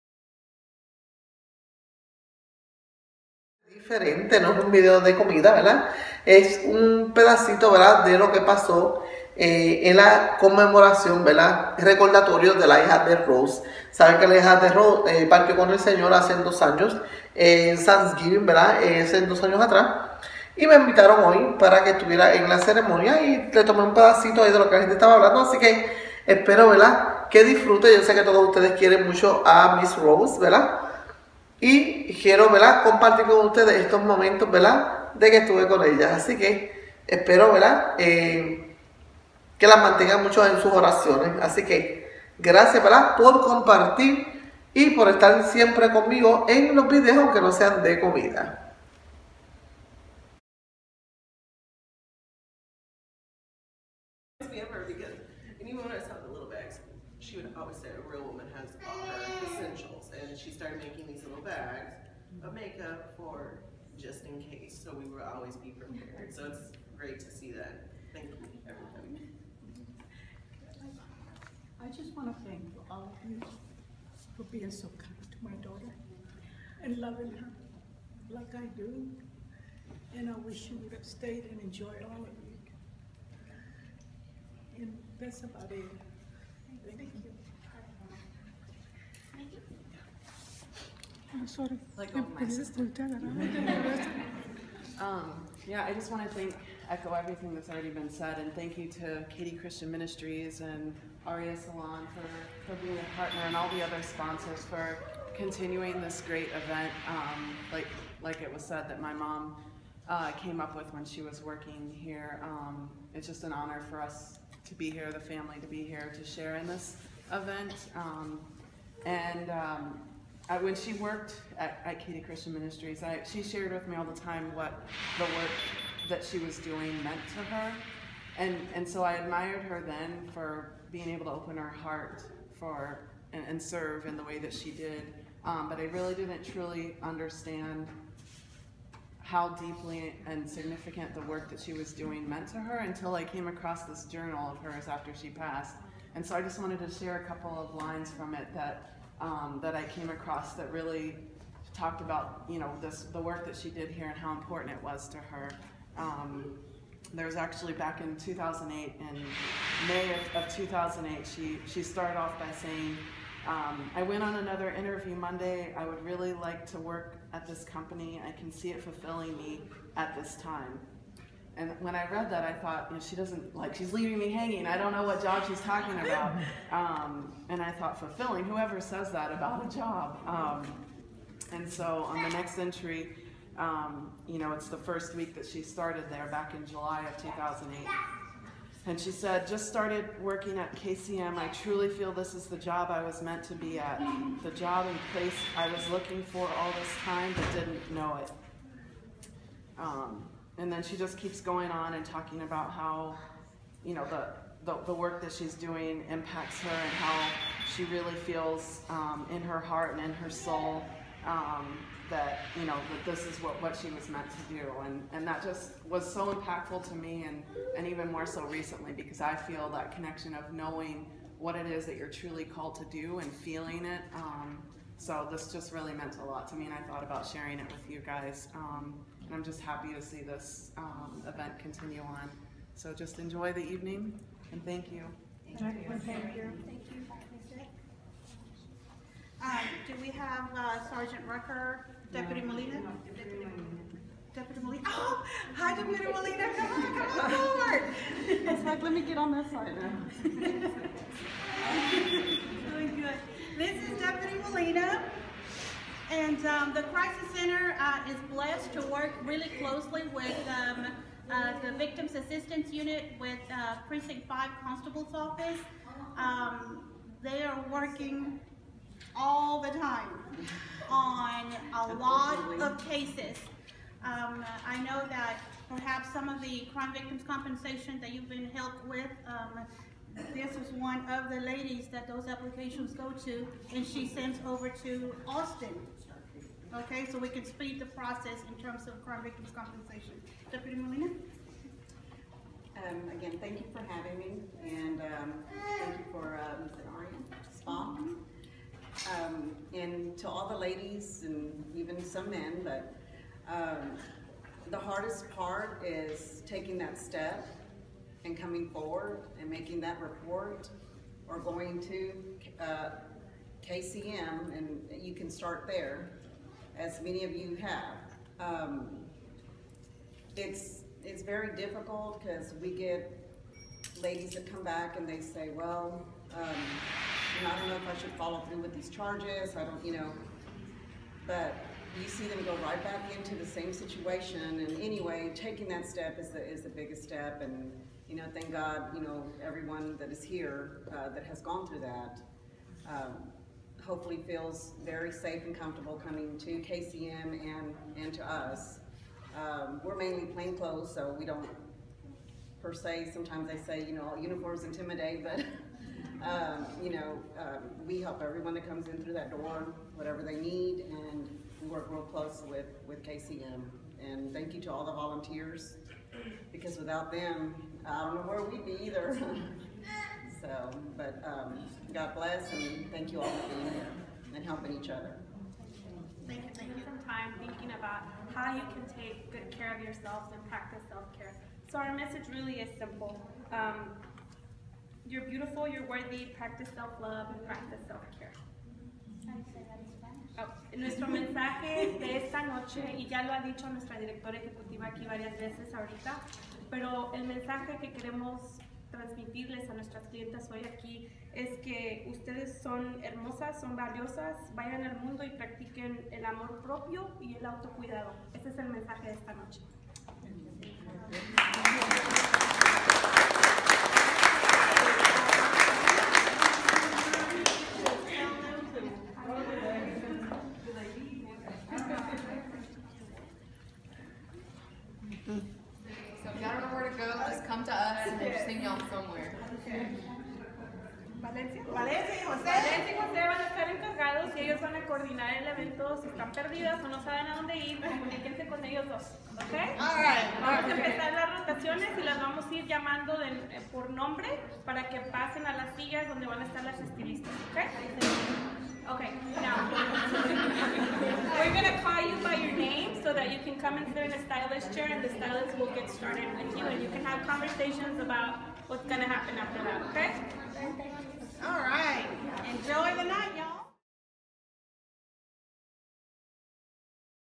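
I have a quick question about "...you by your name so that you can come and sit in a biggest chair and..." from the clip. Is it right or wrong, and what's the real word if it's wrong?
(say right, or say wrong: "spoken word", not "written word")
wrong: "stylist", not "biggest".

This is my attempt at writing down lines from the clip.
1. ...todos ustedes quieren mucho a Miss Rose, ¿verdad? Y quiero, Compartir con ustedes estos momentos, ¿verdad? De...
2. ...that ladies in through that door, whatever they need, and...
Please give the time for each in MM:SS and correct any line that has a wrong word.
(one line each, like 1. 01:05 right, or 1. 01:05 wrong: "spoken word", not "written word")
1. 00:28 right
2. 05:58 wrong: "comes", not "ladies".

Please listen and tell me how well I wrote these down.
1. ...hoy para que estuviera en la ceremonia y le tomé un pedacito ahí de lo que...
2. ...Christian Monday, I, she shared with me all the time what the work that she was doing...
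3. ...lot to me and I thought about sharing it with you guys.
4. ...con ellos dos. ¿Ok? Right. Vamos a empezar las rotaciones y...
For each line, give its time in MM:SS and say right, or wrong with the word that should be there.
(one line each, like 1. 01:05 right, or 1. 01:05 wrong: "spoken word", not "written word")
1. 00:21 right
2. 02:02 wrong: "Ministries", not "Monday"
3. 03:46 right
4. 07:18 right.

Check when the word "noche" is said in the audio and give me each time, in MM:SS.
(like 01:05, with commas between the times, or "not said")
06:32, 06:49.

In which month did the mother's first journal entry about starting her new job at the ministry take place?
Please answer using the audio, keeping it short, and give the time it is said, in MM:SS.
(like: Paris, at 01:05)
July, at 03:06.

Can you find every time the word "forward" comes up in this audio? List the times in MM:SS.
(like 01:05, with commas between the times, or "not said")
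04:07, 05:08.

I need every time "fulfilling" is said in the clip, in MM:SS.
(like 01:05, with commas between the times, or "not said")
02:48, 02:57.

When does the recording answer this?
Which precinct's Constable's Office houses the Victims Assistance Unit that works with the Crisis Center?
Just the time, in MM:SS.
04:23.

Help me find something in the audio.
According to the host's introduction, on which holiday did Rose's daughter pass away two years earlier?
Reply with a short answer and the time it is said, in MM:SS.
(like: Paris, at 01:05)
Thanksgiving, at 00:17.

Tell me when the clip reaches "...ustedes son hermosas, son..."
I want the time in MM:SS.
06:42.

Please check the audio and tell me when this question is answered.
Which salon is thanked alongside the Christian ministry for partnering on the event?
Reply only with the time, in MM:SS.
01:41.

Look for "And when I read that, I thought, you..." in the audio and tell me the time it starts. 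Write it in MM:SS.
02:51.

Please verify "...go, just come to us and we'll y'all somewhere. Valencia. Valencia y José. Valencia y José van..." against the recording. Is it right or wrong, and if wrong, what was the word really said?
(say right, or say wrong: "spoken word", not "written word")
right.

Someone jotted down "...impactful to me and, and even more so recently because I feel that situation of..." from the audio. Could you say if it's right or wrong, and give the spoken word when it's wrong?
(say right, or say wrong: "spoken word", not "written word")
wrong: "connection", not "situation".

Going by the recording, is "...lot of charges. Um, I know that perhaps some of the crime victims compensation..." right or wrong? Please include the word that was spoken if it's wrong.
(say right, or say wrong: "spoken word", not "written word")
wrong: "cases", not "charges".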